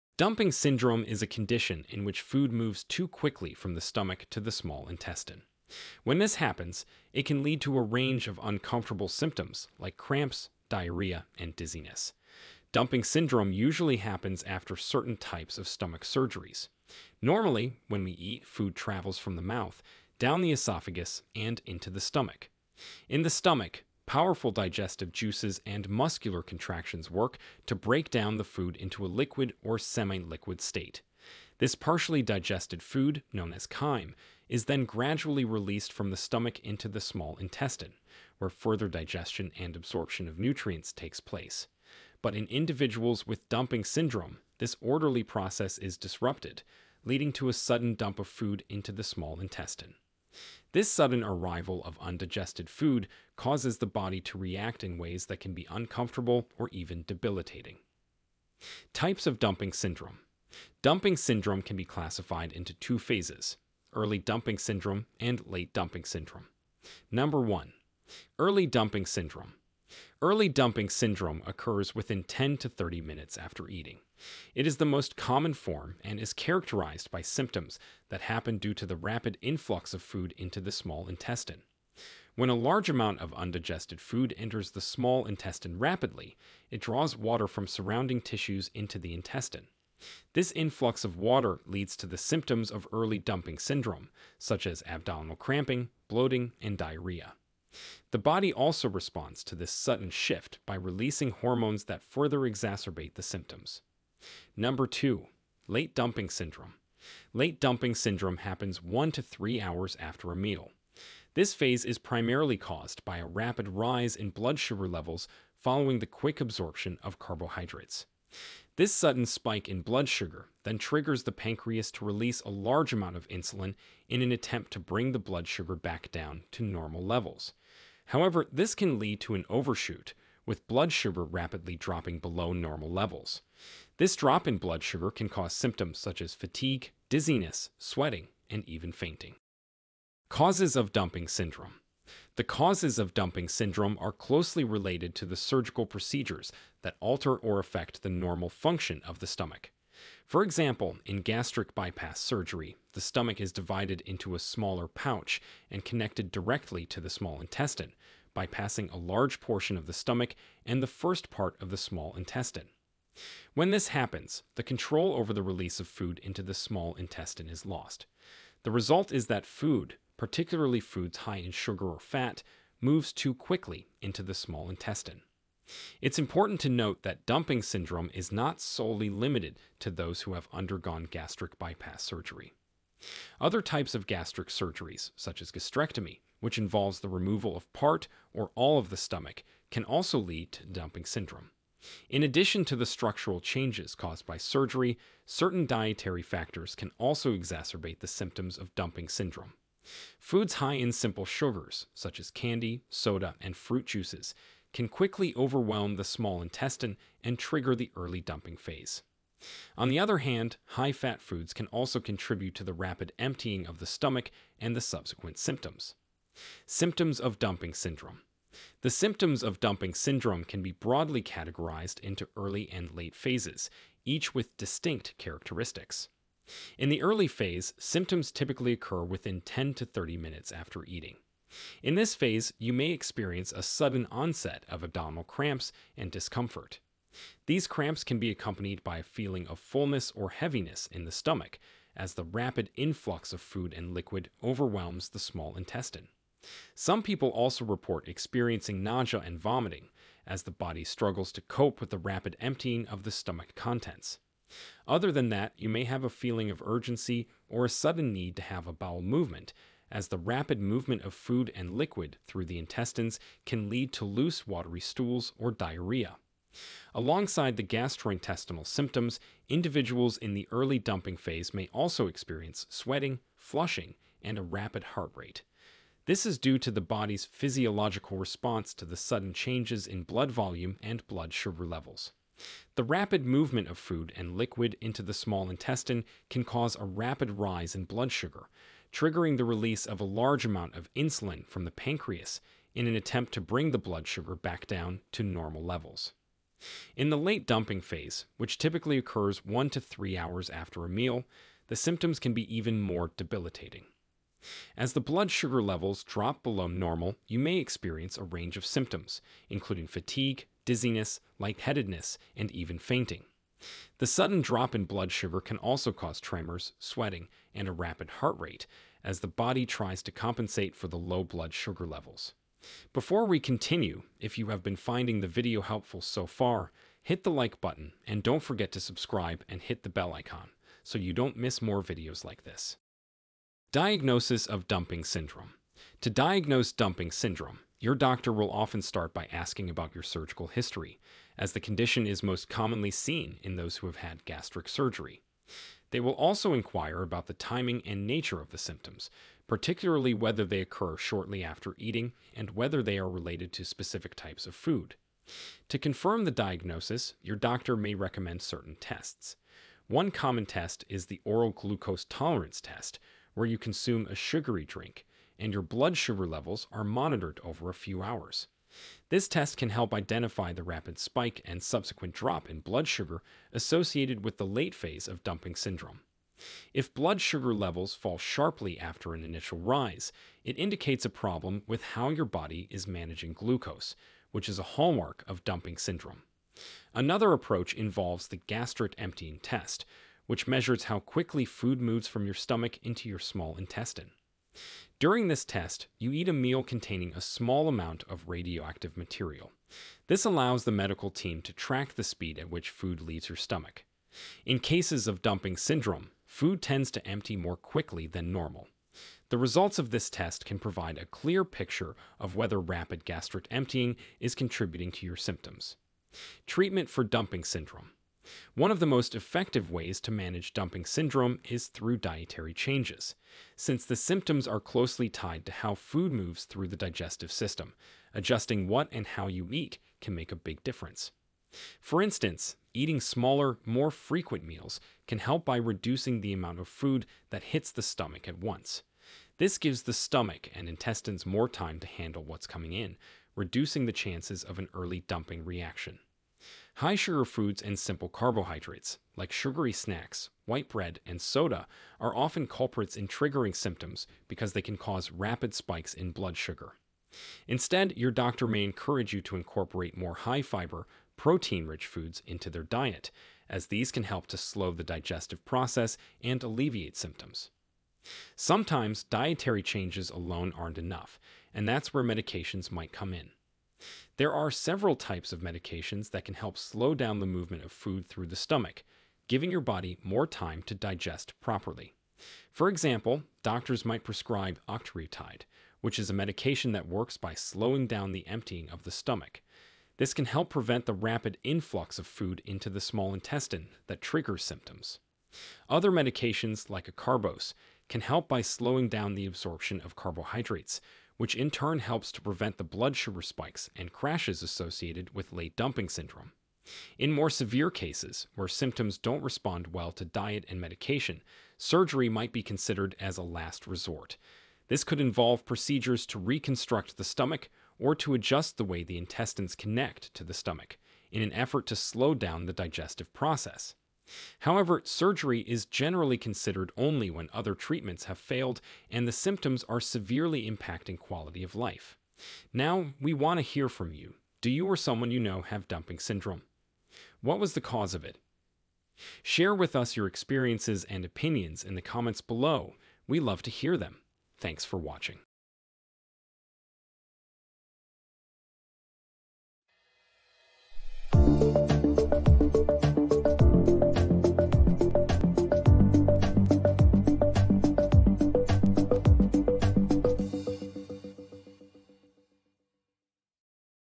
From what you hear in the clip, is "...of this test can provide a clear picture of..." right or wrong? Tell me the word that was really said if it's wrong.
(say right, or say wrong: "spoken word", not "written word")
right.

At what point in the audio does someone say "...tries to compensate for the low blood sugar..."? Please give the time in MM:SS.
05:19.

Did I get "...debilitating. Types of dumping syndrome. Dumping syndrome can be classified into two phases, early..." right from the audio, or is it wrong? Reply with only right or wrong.
right.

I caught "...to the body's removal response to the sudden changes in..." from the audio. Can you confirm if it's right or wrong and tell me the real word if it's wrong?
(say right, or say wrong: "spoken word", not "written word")
wrong: "physiological", not "removal".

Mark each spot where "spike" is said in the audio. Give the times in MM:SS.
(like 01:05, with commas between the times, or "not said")
01:59, 06:10, 07:35, 08:23.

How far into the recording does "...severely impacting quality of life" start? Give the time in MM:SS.
08:49.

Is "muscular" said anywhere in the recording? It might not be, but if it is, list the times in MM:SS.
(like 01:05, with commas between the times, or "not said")
00:25.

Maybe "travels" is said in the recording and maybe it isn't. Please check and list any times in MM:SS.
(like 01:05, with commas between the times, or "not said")
00:18.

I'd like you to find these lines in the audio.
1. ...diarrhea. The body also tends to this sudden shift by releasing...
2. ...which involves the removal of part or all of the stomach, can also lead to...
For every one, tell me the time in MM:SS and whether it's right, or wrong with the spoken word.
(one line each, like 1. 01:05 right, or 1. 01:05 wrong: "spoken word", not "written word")
1. 01:36 wrong: "responds", not "tends"
2. 03:06 right.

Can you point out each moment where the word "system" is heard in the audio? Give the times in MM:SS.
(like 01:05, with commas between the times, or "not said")
07:07.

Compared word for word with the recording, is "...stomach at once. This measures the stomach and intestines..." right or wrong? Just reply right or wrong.
wrong.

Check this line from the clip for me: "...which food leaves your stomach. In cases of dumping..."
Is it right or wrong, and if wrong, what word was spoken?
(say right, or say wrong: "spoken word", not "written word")
right.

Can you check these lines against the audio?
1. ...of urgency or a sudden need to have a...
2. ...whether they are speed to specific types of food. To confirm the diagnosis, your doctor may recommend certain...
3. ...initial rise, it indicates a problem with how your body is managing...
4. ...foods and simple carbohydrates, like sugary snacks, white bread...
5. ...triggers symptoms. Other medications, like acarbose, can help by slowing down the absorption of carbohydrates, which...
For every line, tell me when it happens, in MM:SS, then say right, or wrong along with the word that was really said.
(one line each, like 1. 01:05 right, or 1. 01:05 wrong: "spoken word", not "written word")
1. 04:16 right
2. 05:52 wrong: "related", not "speed"
3. 06:19 right
4. 07:27 right
5. 08:14 right.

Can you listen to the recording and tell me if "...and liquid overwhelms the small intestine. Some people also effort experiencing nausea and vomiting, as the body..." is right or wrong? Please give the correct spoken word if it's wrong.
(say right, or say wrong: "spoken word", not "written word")
wrong: "report", not "effort".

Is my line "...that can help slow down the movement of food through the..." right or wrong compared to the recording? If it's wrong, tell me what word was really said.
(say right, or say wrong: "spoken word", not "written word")
right.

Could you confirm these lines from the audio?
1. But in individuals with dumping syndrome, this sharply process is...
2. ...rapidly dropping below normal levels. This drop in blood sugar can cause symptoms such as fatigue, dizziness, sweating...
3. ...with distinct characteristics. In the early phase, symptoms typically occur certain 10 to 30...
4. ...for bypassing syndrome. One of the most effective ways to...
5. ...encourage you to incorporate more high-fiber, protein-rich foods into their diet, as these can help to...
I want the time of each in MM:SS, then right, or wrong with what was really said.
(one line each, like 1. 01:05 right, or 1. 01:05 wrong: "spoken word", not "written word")
1. 00:42 wrong: "orderly", not "sharply"
2. 02:11 right
3. 03:44 wrong: "within", not "certain"
4. 06:56 wrong: "dumping", not "bypassing"
5. 07:38 right.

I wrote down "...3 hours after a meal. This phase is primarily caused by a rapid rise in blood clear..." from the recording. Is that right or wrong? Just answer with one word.
wrong.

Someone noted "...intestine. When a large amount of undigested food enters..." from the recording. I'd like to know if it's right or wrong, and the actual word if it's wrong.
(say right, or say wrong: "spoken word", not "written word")
right.